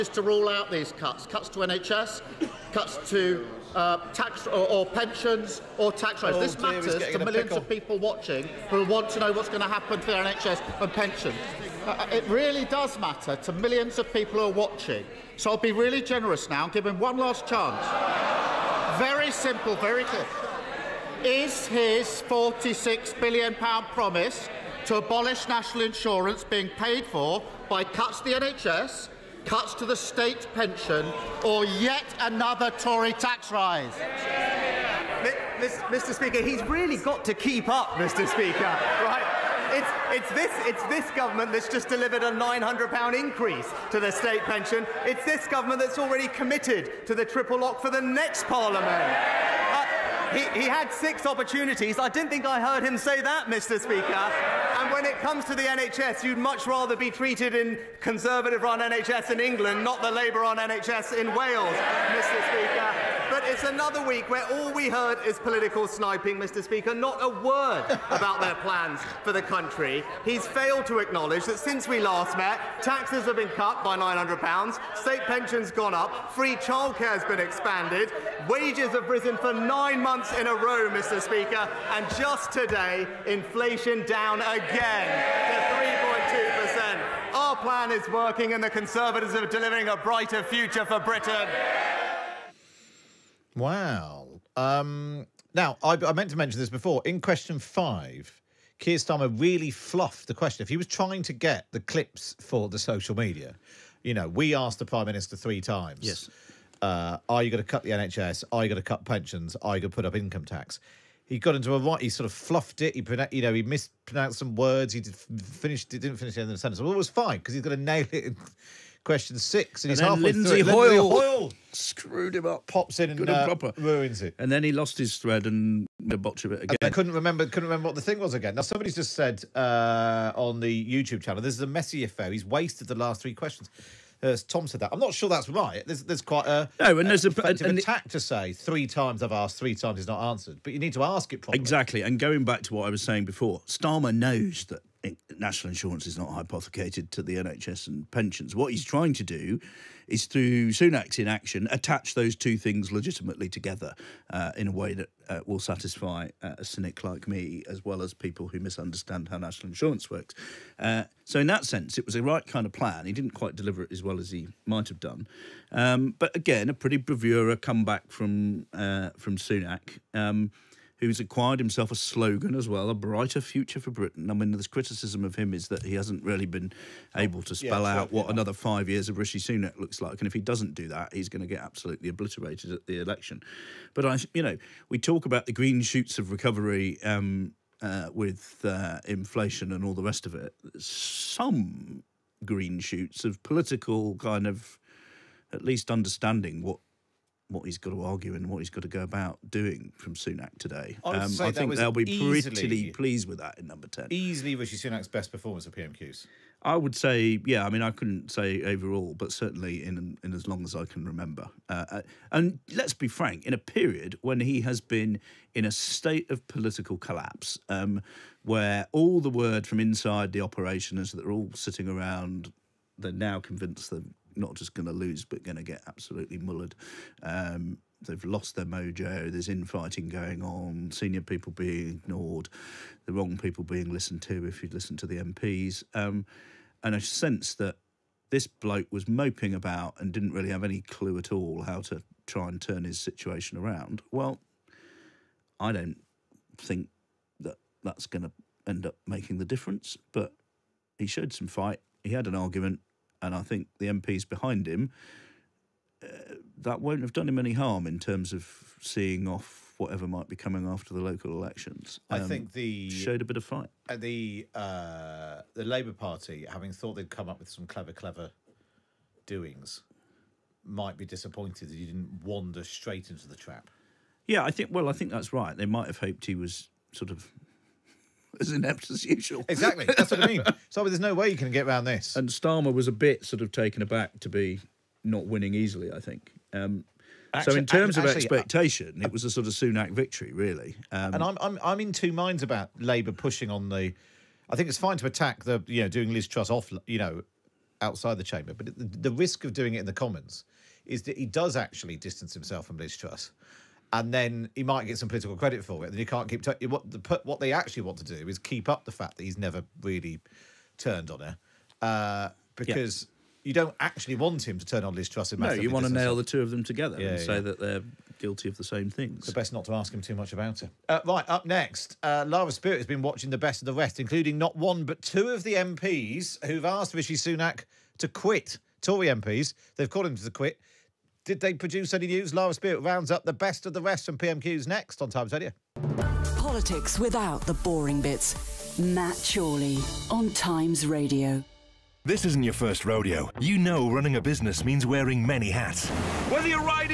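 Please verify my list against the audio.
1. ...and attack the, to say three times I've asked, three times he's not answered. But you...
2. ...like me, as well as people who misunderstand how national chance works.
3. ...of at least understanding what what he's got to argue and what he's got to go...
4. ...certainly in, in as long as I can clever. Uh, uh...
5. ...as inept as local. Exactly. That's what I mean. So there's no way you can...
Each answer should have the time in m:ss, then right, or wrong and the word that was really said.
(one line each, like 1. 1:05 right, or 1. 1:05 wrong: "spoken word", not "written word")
1. 2:17 right
2. 2:37 wrong: "insurance", not "chance"
3. 3:14 right
4. 3:29 wrong: "remember", not "clever"
5. 4:38 wrong: "usual", not "local".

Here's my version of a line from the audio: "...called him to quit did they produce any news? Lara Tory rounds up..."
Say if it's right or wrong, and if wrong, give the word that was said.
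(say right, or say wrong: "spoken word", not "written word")
wrong: "Spirit", not "Tory".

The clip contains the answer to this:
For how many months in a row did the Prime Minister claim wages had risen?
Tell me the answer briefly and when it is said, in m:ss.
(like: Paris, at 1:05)
9, at 1:19.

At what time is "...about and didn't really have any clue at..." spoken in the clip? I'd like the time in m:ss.
3:59.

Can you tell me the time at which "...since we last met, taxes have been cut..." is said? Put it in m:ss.
1:11.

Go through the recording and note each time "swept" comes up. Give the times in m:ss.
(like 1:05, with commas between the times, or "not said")
not said.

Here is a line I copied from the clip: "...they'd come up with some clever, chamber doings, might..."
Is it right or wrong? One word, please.
wrong.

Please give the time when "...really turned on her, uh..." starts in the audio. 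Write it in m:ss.
5:09.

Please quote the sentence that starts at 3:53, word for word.
The wrong people being listened to.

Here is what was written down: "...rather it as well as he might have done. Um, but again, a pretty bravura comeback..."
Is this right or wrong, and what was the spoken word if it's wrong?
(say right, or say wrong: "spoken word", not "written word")
wrong: "deliver", not "rather".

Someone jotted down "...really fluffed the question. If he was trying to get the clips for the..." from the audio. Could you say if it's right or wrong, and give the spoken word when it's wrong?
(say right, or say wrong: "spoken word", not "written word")
right.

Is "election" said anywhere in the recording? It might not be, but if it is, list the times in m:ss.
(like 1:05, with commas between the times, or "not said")
3:02, 4:21.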